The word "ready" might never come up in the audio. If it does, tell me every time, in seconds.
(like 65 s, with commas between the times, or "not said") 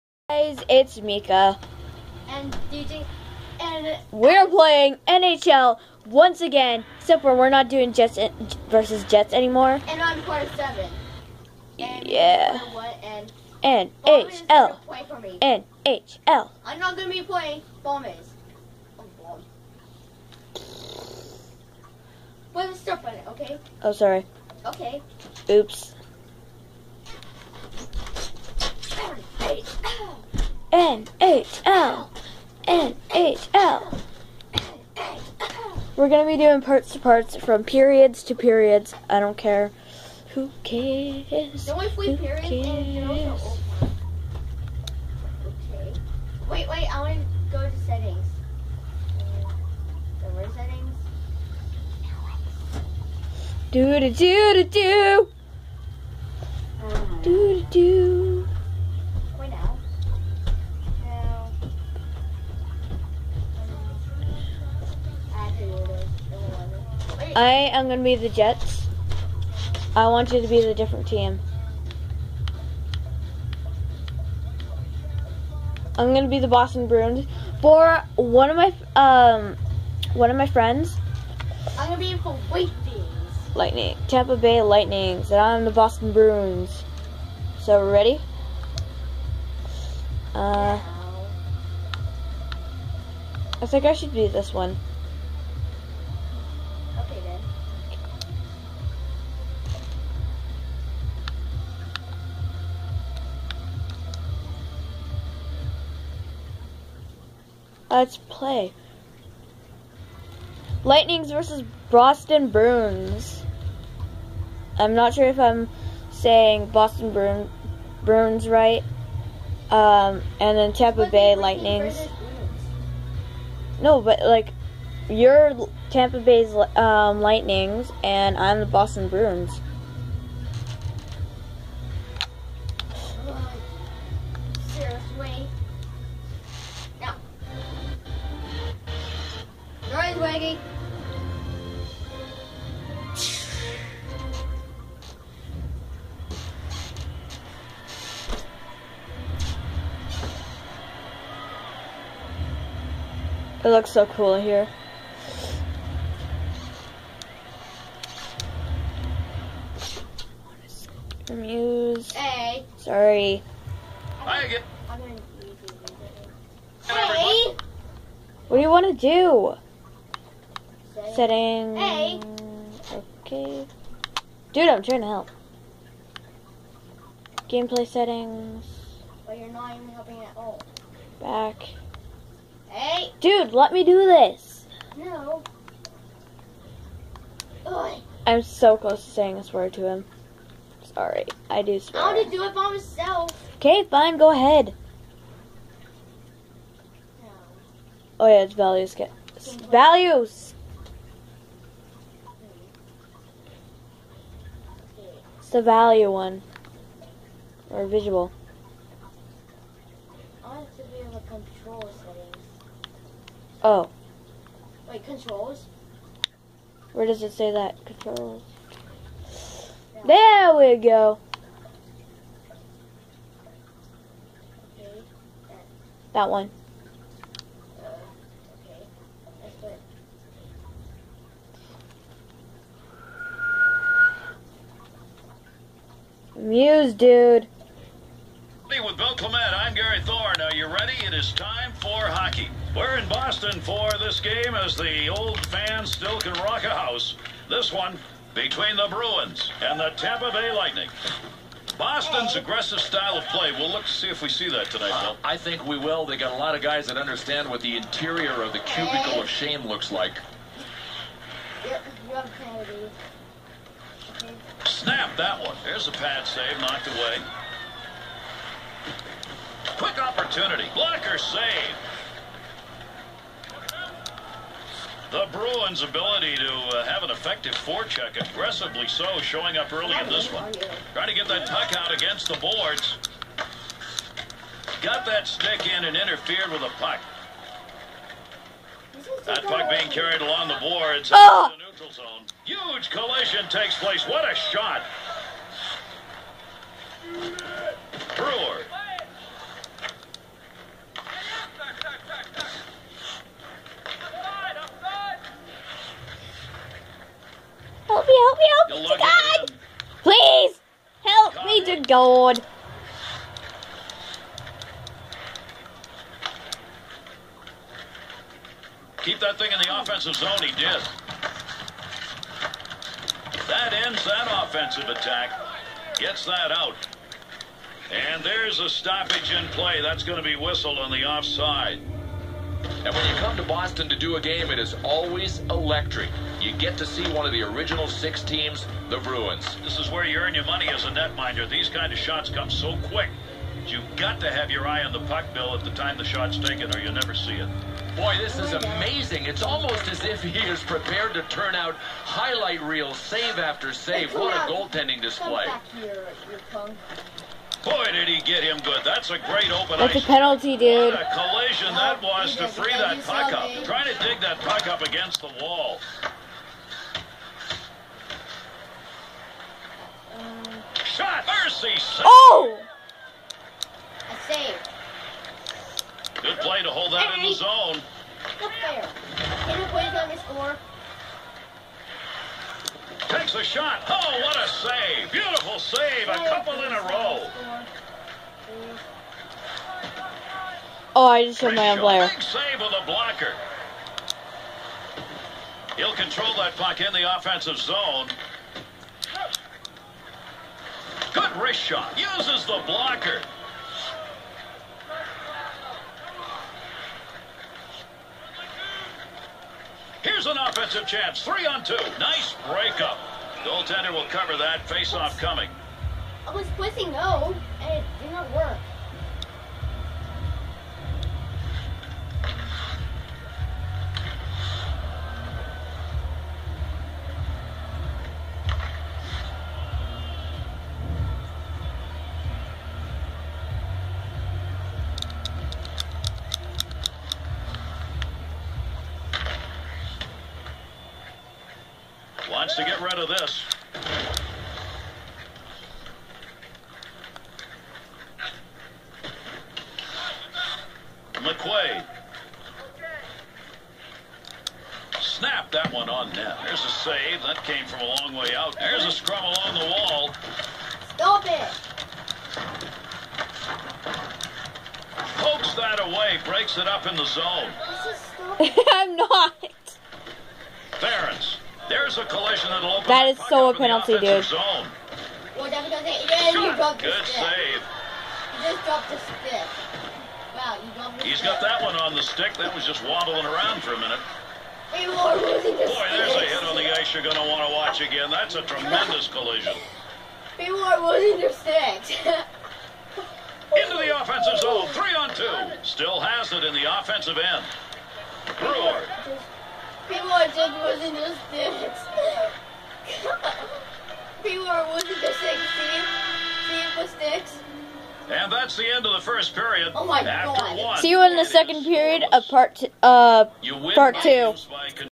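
87 s, 240 s.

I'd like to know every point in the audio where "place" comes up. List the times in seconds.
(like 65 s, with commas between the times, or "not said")
293 s.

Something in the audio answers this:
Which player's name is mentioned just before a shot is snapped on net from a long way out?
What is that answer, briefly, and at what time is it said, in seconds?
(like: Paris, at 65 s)
McQuaid, at 451 s.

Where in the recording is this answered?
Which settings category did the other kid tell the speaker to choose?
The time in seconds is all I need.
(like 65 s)
211 s.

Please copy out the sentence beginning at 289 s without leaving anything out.
That puck being carried along the boards.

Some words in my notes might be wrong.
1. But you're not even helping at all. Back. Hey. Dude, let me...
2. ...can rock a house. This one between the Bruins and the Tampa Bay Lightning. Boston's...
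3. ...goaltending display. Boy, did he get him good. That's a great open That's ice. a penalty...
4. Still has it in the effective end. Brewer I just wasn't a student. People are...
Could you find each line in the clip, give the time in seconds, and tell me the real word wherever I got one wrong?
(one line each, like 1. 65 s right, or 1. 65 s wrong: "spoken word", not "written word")
1. 179 s right
2. 246 s right
3. 354 s right
4. 495 s wrong: "offensive", not "effective".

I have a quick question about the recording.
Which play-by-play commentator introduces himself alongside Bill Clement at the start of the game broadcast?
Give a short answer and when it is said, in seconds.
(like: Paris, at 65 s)
Gary Thorne, at 239 s.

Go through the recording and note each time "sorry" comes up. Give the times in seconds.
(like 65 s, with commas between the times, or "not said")
23 s, 162 s, 190 s.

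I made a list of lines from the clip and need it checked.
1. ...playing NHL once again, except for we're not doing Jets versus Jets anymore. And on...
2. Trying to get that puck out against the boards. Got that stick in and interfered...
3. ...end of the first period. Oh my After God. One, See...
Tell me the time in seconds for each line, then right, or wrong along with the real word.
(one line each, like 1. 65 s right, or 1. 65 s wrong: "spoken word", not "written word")
1. 4 s right
2. 280 s right
3. 508 s right.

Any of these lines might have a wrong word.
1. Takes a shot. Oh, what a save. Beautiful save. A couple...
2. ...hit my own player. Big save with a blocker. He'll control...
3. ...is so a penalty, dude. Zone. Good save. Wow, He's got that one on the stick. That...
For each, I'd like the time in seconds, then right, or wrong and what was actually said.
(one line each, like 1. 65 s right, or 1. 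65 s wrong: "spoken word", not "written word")
1. 383 s right
2. 391 s right
3. 473 s right.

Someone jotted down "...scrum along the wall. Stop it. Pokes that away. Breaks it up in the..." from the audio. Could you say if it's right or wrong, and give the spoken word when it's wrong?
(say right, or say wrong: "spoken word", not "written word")
right.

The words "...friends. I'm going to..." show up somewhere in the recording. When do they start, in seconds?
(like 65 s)
80 s.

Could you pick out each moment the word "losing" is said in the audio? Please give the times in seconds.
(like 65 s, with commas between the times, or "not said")
490 s, 504 s.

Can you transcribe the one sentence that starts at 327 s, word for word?
And there's a stoppage in play.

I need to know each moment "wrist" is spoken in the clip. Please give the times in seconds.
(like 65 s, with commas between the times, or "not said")
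401 s.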